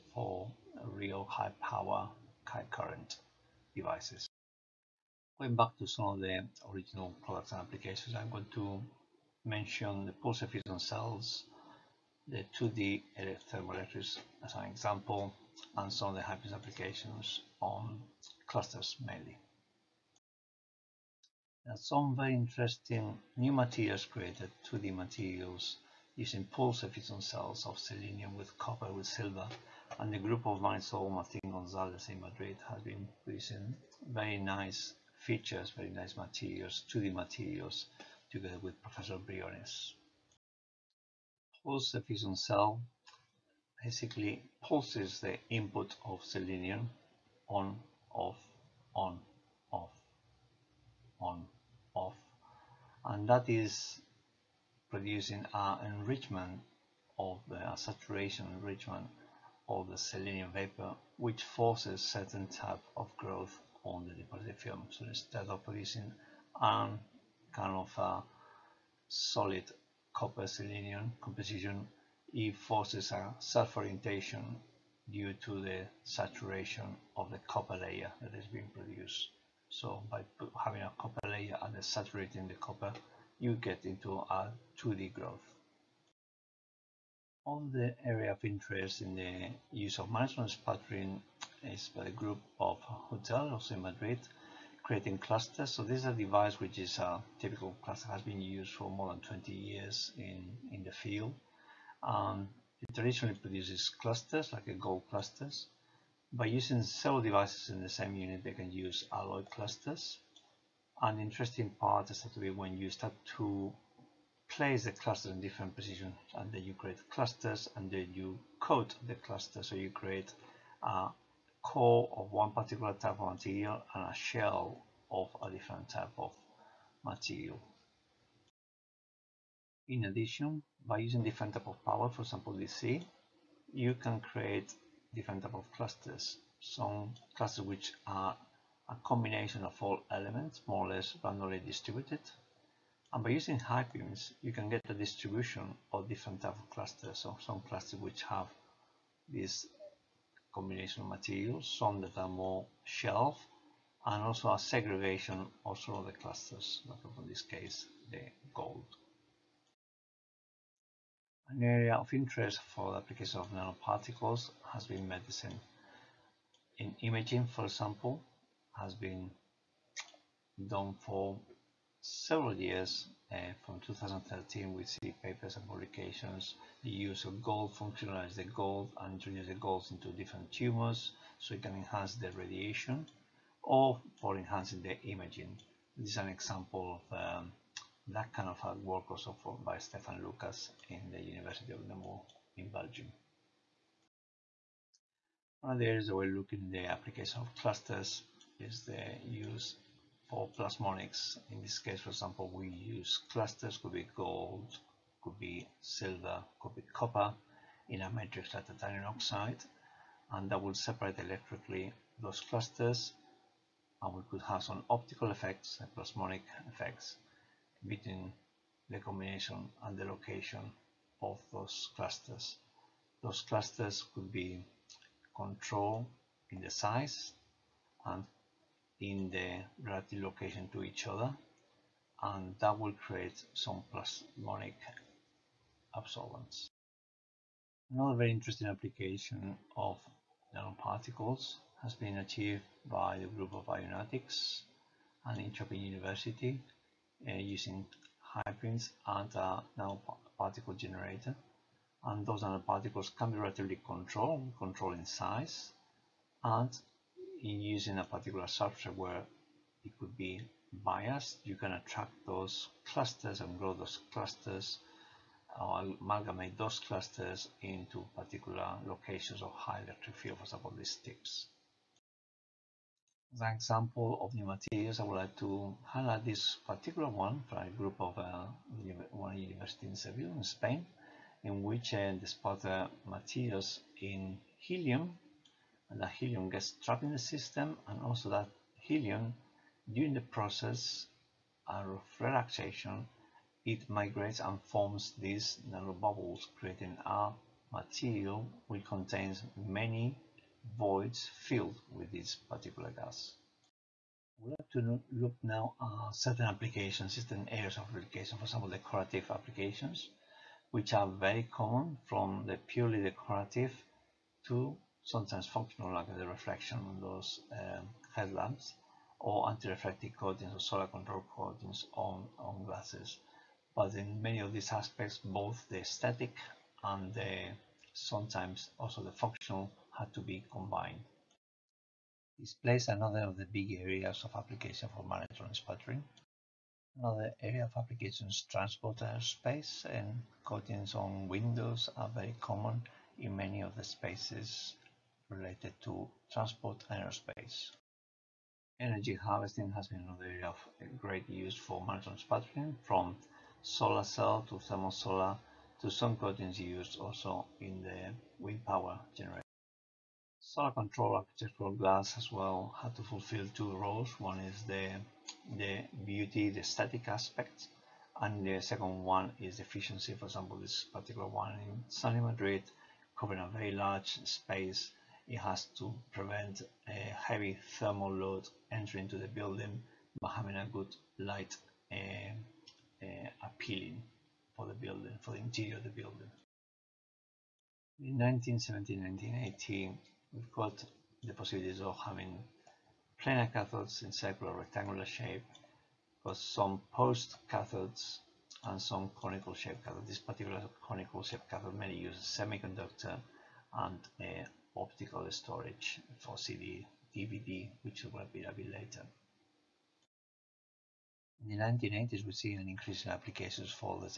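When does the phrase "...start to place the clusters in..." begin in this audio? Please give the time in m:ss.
1:52.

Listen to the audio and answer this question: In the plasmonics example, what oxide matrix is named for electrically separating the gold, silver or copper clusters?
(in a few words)
Titanium oxide.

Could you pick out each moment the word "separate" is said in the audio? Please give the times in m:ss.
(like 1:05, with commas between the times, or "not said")
3:30.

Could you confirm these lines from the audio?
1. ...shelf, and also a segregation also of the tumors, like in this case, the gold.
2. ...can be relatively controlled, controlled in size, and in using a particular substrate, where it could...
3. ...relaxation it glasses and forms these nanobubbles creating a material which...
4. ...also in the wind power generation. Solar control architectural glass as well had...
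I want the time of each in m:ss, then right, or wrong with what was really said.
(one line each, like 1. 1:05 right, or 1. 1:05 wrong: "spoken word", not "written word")
1. 2:32 wrong: "clusters", not "tumors"
2. 4:13 right
3. 4:52 wrong: "migrates", not "glasses"
4. 5:56 right.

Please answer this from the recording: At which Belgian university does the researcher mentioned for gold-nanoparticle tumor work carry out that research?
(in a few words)
University of Namur.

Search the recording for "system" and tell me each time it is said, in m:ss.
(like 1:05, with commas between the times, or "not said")
4:47.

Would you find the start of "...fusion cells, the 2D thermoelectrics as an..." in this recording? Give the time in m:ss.
0:10.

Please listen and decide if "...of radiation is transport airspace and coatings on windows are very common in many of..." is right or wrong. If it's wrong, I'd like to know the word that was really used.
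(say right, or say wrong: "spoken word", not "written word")
wrong: "application", not "radiation".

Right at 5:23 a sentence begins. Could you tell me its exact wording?
But in many of these aspects, both the aesthetic and the sometimes also the functional had to be combined.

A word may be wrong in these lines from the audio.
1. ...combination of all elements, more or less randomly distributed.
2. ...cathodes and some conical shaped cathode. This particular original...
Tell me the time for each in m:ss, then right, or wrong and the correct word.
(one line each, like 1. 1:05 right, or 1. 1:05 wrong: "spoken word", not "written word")
1. 2:19 right
2. 6:37 wrong: "conical", not "original".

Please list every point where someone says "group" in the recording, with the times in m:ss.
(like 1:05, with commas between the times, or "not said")
0:30, 1:32, 4:03, 4:37.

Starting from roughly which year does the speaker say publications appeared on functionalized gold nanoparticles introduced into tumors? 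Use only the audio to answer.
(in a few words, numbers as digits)
2013.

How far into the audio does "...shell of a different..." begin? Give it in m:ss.
2:04.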